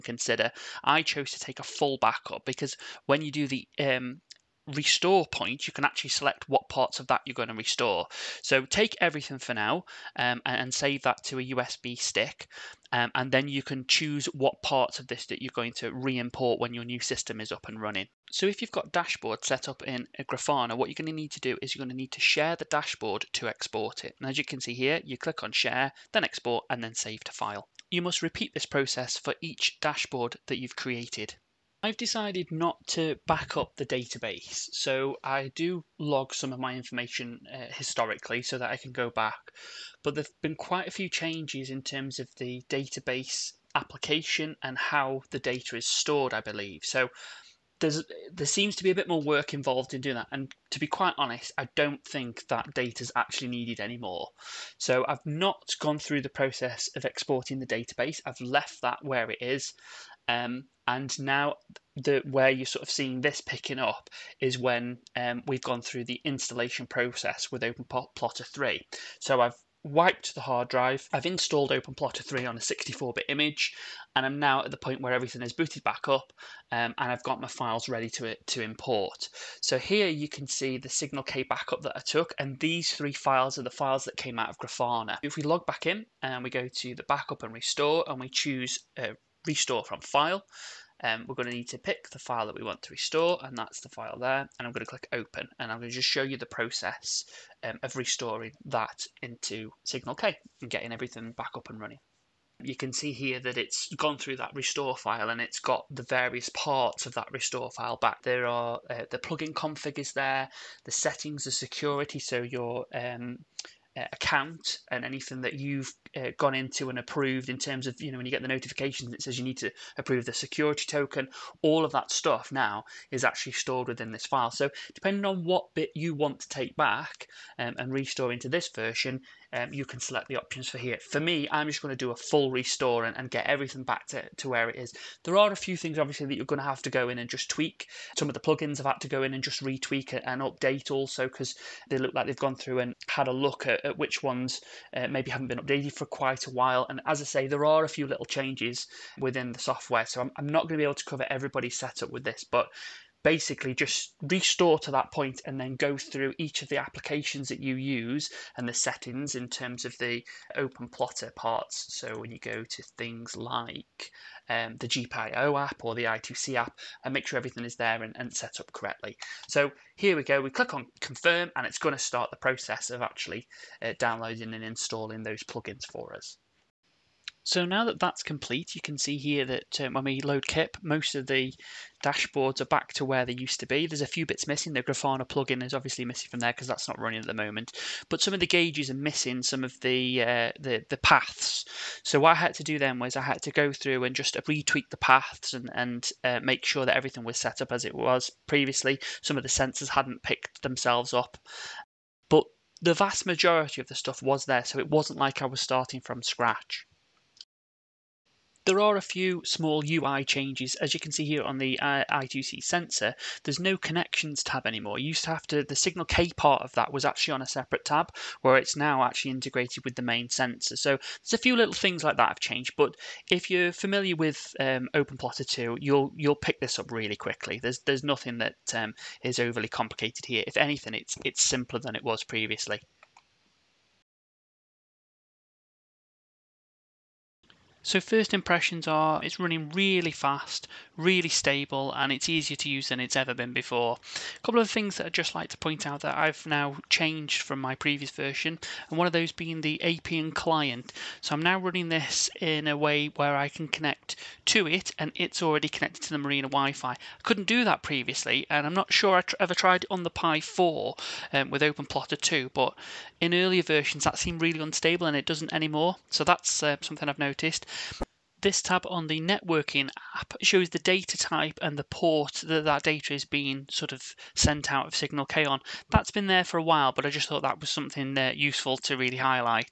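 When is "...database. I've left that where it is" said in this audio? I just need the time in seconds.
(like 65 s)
57 s.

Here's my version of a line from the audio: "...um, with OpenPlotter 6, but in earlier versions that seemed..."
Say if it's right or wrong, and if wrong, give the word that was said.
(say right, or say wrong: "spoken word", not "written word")
wrong: "2", not "6".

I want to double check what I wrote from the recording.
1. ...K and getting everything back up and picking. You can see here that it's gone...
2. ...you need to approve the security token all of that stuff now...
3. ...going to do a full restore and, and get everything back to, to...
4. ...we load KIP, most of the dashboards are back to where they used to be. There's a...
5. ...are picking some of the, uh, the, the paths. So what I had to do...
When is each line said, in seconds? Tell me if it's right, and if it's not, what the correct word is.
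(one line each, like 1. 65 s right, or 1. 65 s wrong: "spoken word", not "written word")
1. 100 s wrong: "running", not "picking"
2. 119 s right
3. 131 s right
4. 180 s right
5. 188 s wrong: "missing", not "picking".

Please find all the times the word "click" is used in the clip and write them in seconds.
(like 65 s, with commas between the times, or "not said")
25 s, 94 s, 170 s.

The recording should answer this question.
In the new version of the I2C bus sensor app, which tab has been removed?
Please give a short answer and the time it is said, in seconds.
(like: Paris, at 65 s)
connections tab, at 213 s.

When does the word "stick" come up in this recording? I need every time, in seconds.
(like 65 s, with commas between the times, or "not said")
11 s.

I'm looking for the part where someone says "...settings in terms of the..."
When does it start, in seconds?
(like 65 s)
158 s.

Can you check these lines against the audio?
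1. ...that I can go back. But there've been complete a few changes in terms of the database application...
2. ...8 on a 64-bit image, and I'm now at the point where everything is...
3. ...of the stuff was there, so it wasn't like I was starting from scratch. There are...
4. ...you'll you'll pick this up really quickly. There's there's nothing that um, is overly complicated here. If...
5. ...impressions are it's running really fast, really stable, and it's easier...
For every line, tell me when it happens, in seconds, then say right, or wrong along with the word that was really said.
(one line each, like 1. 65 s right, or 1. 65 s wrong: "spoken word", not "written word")
1. 38 s wrong: "quite", not "complete"
2. 72 s wrong: "3", not "8"
3. 203 s right
4. 225 s right
5. 238 s right.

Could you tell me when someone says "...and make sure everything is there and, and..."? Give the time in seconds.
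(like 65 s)
167 s.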